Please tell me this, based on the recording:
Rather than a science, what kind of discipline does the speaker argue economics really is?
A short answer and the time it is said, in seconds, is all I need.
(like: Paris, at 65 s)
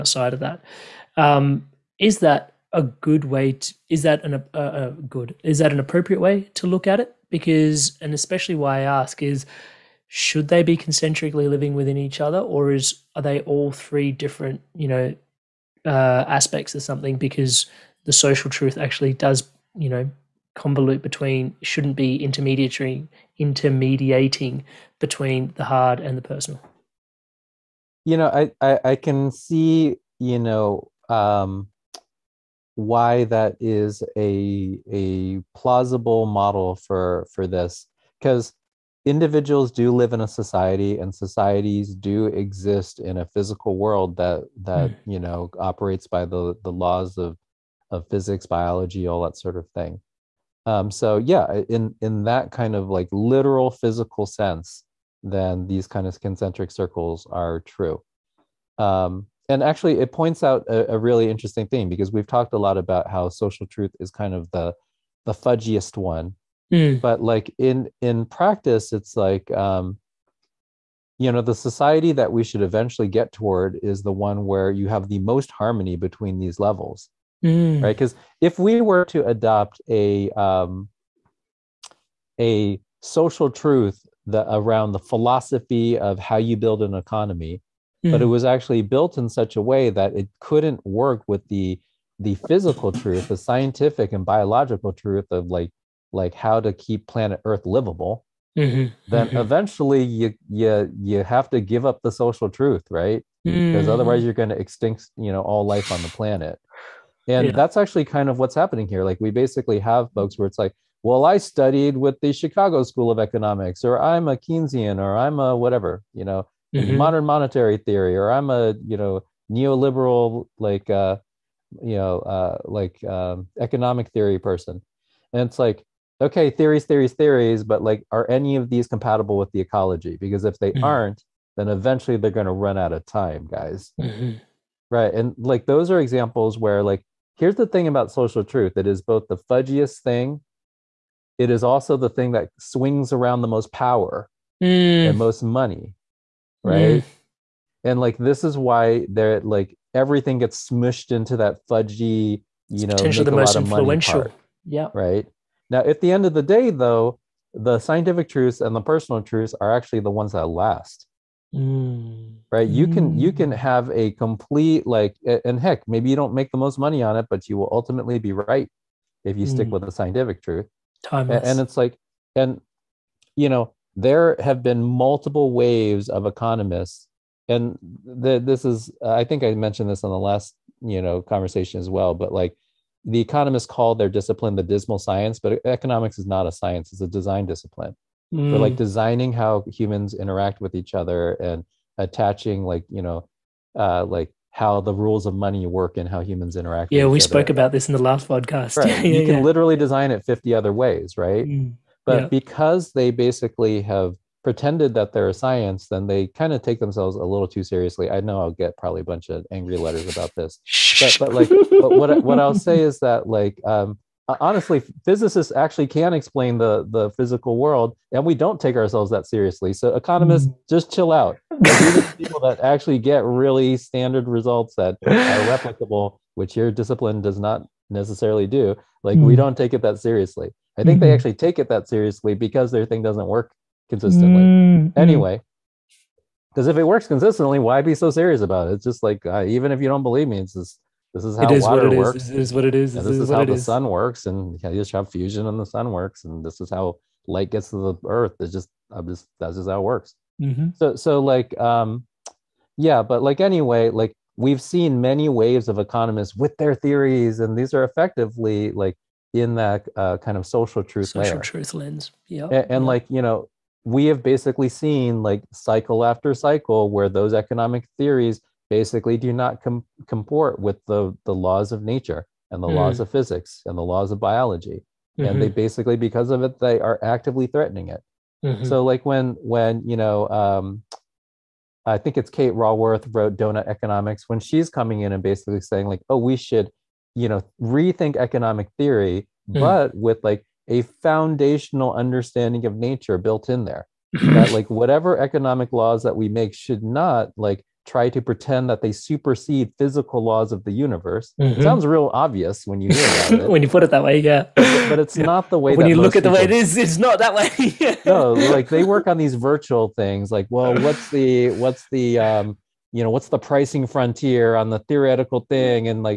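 a design discipline, at 187 s.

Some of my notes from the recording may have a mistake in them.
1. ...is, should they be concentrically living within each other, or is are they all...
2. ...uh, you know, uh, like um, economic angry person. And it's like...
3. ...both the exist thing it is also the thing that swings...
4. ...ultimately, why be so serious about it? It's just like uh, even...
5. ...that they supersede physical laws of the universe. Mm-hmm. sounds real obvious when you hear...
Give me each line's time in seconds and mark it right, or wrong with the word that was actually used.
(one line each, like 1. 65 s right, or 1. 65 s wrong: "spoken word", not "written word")
1. 9 s right
2. 120 s wrong: "theory", not "angry"
3. 139 s wrong: "fudgiest", not "exist"
4. 237 s wrong: "consistently", not "ultimately"
5. 298 s right.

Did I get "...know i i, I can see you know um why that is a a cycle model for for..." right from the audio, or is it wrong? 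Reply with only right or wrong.
wrong.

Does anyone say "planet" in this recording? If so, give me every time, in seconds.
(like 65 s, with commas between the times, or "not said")
97 s, 106 s.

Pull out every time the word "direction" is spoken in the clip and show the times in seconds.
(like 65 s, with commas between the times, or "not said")
not said.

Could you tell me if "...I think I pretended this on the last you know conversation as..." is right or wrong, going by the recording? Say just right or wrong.
wrong.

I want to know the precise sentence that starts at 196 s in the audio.
Yeah, we spoke about this in the last podcast.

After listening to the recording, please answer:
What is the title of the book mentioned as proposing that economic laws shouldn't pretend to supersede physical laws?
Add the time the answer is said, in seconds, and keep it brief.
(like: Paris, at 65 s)
Doughnut Economics, at 283 s.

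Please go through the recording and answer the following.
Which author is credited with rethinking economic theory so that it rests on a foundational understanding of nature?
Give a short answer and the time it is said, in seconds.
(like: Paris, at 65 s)
Kate Raworth, at 282 s.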